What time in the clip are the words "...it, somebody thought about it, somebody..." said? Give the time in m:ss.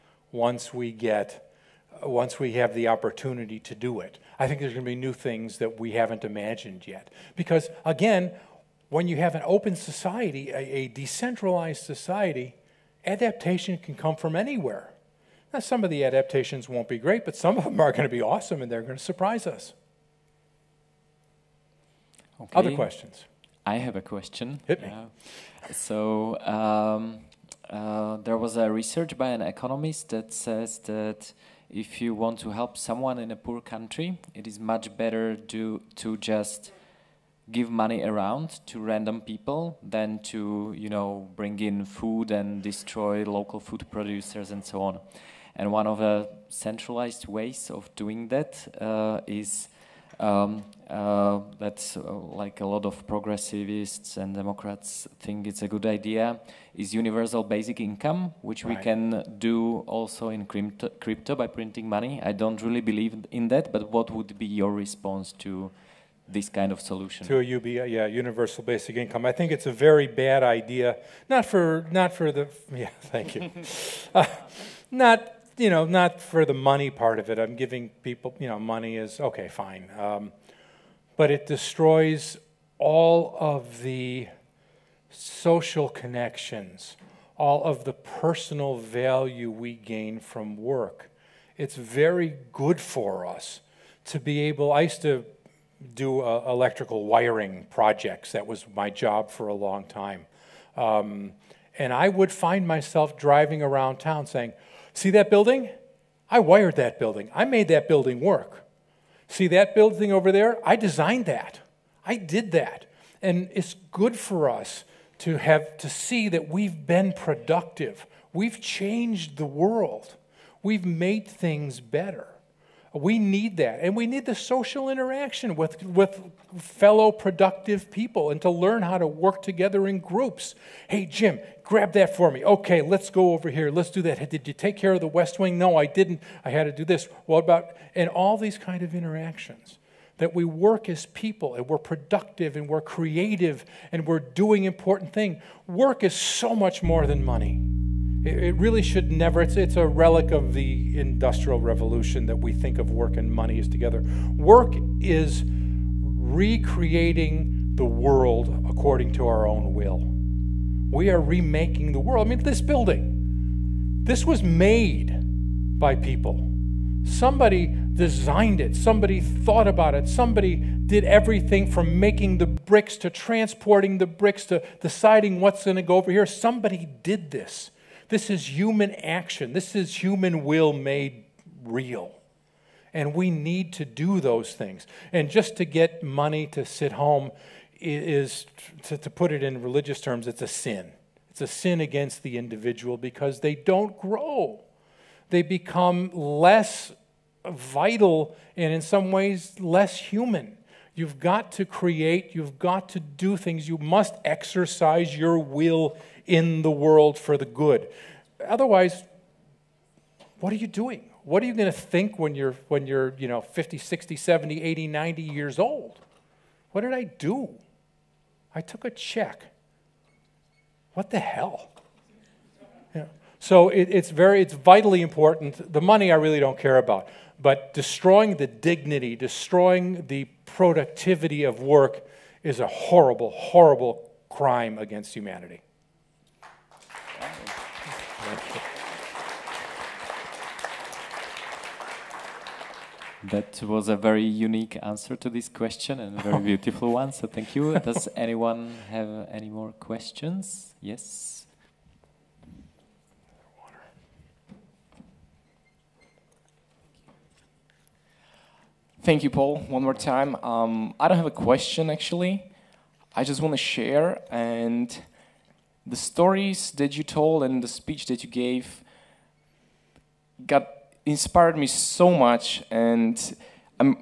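2:48.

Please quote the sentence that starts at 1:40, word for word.
Um, and I would find myself driving around town saying, See that building?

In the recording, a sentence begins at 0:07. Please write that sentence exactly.
Because, again, when you have an open society, a, a decentralized society, adaptation can come from anywhere.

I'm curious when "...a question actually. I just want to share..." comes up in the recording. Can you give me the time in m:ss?
4:21.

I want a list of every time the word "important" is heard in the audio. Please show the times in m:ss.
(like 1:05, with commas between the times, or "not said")
2:24, 3:44.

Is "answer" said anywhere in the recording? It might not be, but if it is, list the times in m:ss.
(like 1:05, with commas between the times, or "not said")
4:04.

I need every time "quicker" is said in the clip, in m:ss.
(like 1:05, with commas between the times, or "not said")
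not said.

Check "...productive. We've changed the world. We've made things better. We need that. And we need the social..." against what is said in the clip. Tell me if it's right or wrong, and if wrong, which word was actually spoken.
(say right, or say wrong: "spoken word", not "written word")
right.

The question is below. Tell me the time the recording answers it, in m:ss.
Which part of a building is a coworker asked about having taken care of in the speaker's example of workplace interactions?
2:15.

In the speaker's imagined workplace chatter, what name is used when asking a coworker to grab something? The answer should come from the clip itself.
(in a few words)
Jim.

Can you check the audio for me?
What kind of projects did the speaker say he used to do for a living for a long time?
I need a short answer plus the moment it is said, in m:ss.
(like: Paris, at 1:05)
Electrical wiring, at 1:36.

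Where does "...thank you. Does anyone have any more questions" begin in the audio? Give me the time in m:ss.
4:07.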